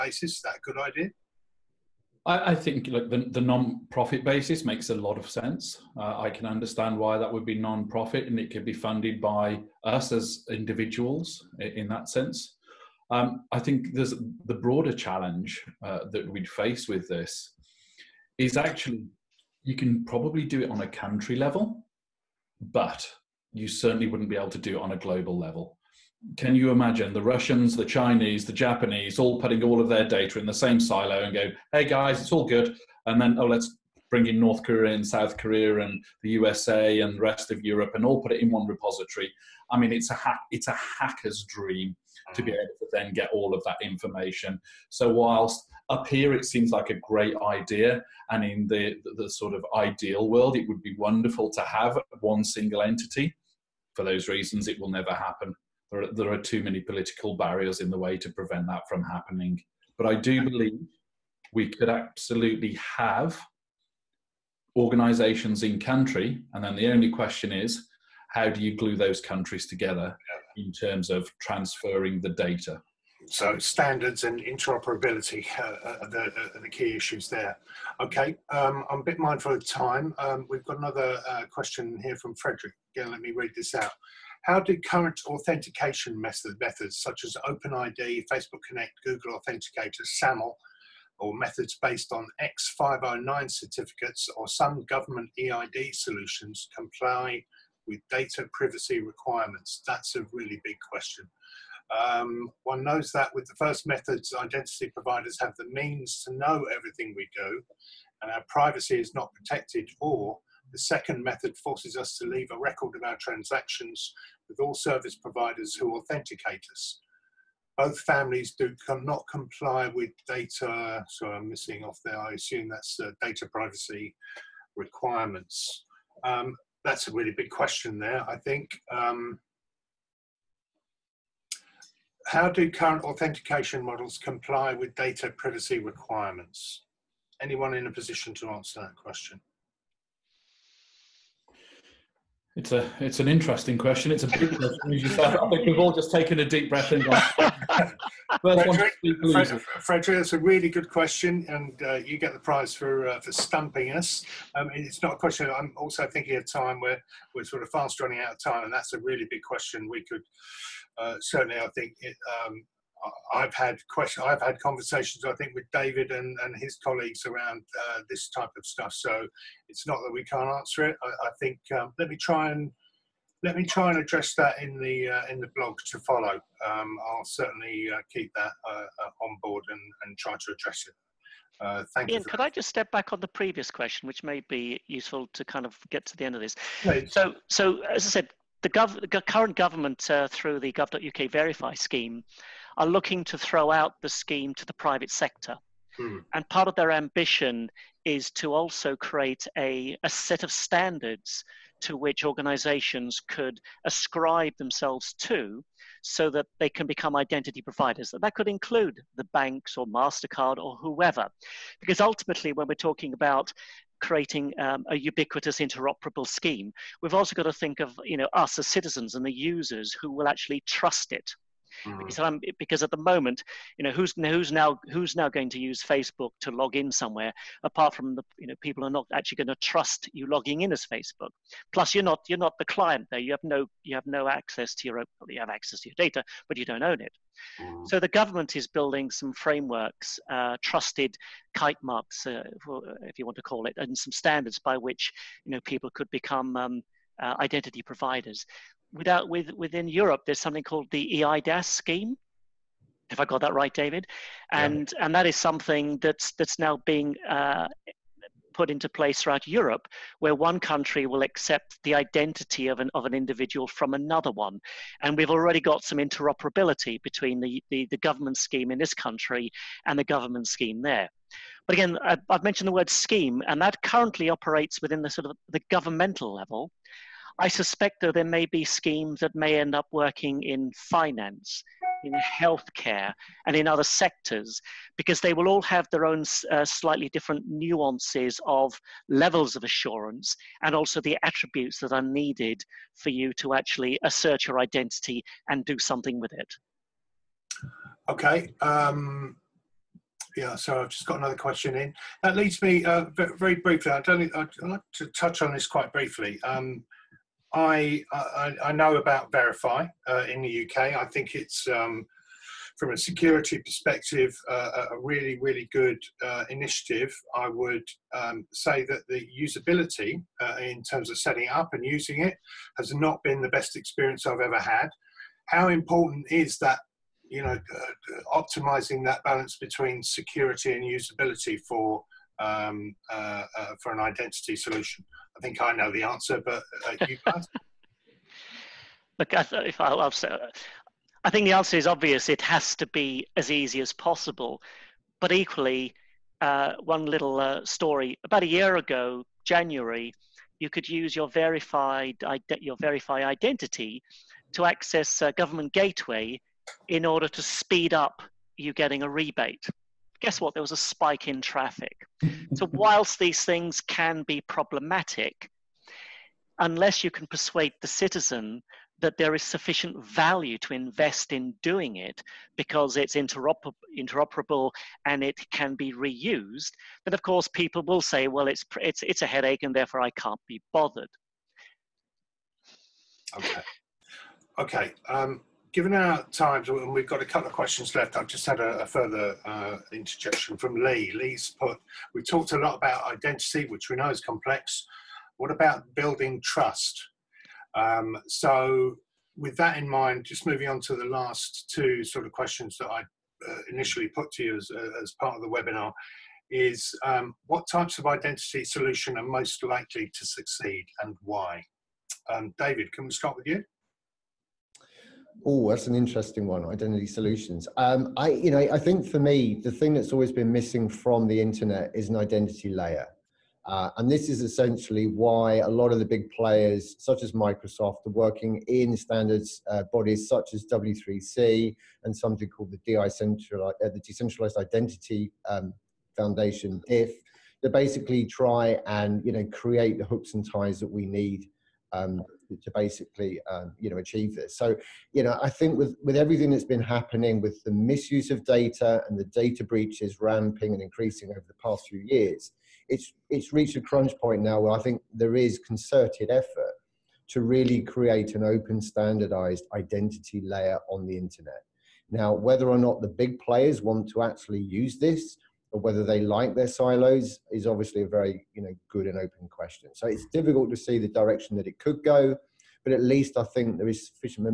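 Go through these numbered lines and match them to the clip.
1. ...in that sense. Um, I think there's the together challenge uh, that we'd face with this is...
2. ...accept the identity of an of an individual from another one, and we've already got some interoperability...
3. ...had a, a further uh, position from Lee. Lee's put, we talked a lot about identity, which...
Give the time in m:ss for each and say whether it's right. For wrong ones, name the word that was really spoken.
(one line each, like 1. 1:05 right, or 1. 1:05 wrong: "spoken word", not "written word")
1. 0:11 wrong: "broader", not "together"
2. 4:21 right
3. 6:28 wrong: "interjection", not "position".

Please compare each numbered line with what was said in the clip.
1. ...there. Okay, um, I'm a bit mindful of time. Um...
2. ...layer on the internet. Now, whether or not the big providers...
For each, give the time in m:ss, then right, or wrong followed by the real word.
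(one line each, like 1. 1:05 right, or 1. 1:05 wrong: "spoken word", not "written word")
1. 1:17 right
2. 7:40 wrong: "players", not "providers".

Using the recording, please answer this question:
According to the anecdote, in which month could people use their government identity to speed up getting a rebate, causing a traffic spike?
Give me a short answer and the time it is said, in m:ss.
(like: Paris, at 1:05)
January, at 5:49.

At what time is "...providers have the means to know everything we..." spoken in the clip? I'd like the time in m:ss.
1:44.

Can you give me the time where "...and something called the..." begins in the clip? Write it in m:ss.
7:12.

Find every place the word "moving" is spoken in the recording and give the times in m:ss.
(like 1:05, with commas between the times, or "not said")
6:40.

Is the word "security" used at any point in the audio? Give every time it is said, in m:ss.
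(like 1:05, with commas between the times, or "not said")
5:12, 5:30.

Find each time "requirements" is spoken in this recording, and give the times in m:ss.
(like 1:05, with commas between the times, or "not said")
1:39, 2:04, 2:15.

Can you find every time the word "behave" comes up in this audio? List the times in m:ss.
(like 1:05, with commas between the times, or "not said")
not said.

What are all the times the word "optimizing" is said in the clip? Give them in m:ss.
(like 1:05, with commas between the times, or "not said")
5:28.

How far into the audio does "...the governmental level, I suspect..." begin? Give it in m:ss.
4:35.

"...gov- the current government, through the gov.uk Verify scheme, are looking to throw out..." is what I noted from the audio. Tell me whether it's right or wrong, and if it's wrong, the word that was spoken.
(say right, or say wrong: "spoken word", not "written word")
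right.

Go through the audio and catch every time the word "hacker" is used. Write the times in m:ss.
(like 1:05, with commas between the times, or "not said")
0:40.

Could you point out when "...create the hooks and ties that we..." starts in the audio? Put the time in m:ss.
7:19.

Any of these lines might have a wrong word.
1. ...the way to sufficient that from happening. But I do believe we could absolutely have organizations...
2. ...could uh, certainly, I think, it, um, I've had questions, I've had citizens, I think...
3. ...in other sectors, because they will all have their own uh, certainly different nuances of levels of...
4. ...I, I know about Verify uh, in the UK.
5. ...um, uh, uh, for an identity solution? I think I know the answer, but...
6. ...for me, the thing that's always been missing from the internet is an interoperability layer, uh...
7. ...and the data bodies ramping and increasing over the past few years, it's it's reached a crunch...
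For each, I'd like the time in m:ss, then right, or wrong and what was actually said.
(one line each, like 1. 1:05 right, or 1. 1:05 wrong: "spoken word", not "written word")
1. 0:57 wrong: "prevent", not "sufficient"
2. 2:40 wrong: "conversations", not "citizens"
3. 4:43 wrong: "slightly", not "certainly"
4. 5:08 right
5. 5:32 right
6. 6:59 wrong: "identity", not "interoperability"
7. 7:29 wrong: "breaches", not "bodies".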